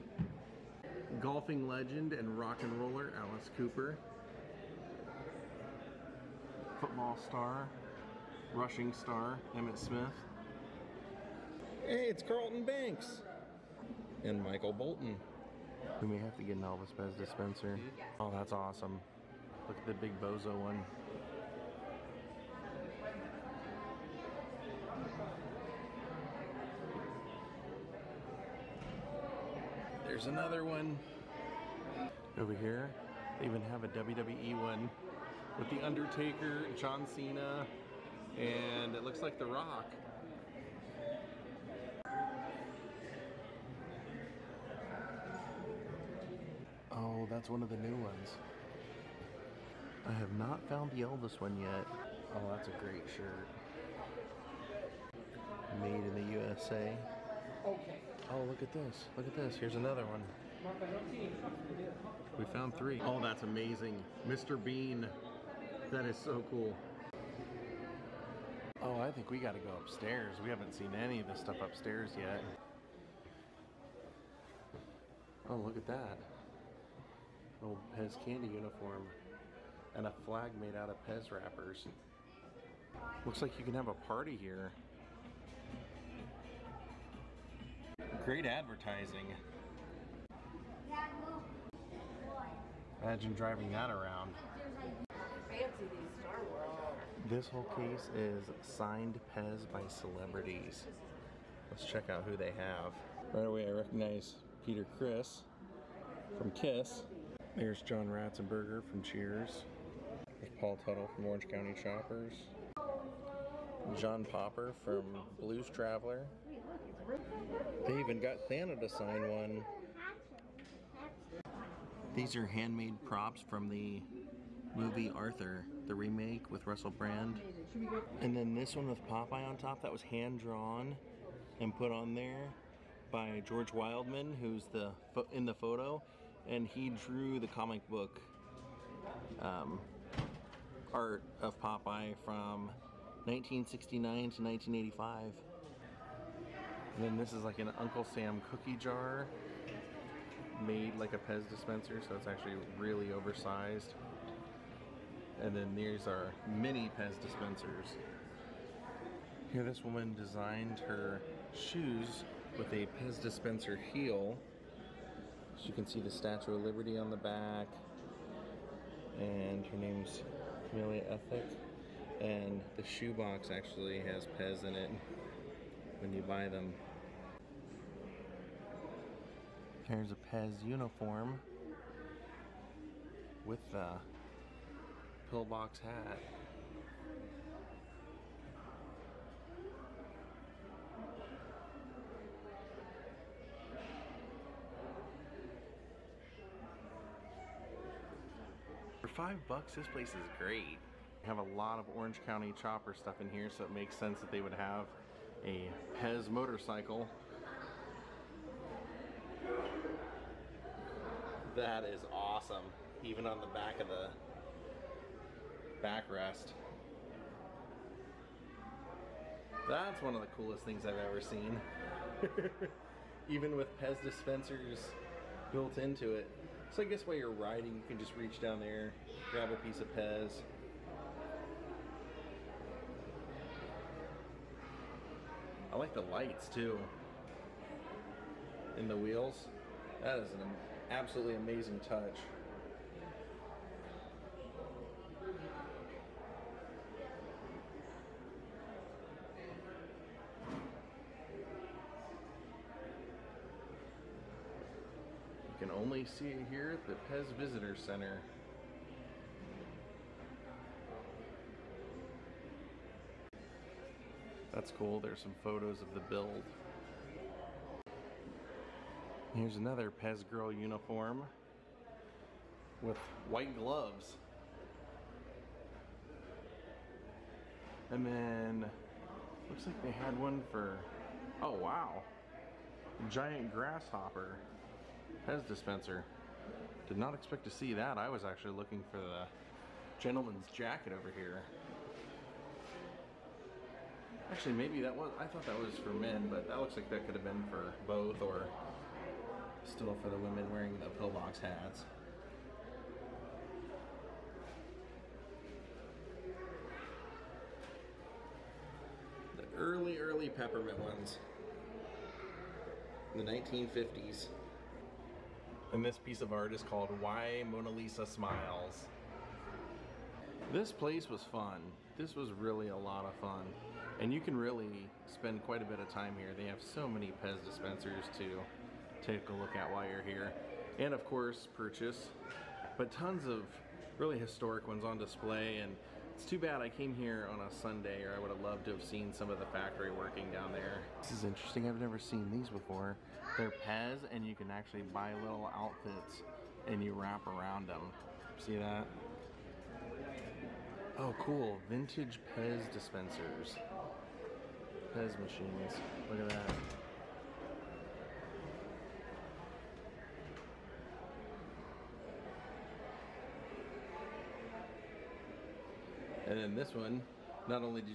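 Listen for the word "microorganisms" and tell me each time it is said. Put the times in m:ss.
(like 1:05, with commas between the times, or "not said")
not said.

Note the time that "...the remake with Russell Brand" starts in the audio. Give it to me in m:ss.
2:05.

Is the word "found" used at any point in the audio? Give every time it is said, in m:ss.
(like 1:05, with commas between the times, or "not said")
0:50, 1:02.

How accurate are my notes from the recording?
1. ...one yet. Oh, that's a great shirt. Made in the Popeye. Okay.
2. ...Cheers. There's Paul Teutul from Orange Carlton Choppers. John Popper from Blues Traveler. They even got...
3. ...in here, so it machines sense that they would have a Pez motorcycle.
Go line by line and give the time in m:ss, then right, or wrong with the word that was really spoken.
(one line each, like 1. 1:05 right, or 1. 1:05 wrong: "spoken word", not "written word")
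1. 0:51 wrong: "USA", not "Popeye"
2. 1:49 wrong: "County", not "Carlton"
3. 3:23 wrong: "makes", not "machines".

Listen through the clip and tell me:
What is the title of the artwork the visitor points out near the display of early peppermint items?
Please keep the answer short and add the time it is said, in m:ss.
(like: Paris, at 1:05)
Why Mona Lisa Smiles, at 5:16.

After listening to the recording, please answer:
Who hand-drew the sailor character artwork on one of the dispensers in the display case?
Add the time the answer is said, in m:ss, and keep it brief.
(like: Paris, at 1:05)
George Wildman, at 2:13.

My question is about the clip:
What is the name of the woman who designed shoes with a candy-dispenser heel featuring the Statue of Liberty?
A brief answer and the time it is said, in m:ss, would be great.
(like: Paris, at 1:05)
Amelia Ethic, at 2:50.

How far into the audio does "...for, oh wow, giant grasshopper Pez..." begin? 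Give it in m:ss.
4:40.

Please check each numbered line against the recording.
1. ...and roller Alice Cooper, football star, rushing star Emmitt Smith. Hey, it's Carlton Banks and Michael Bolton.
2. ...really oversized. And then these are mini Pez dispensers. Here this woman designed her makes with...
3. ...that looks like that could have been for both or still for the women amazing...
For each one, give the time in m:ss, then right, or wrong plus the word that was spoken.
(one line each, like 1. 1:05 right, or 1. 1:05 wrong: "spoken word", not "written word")
1. 0:02 right
2. 2:32 wrong: "shoes", not "makes"
3. 4:56 wrong: "wearing", not "amazing".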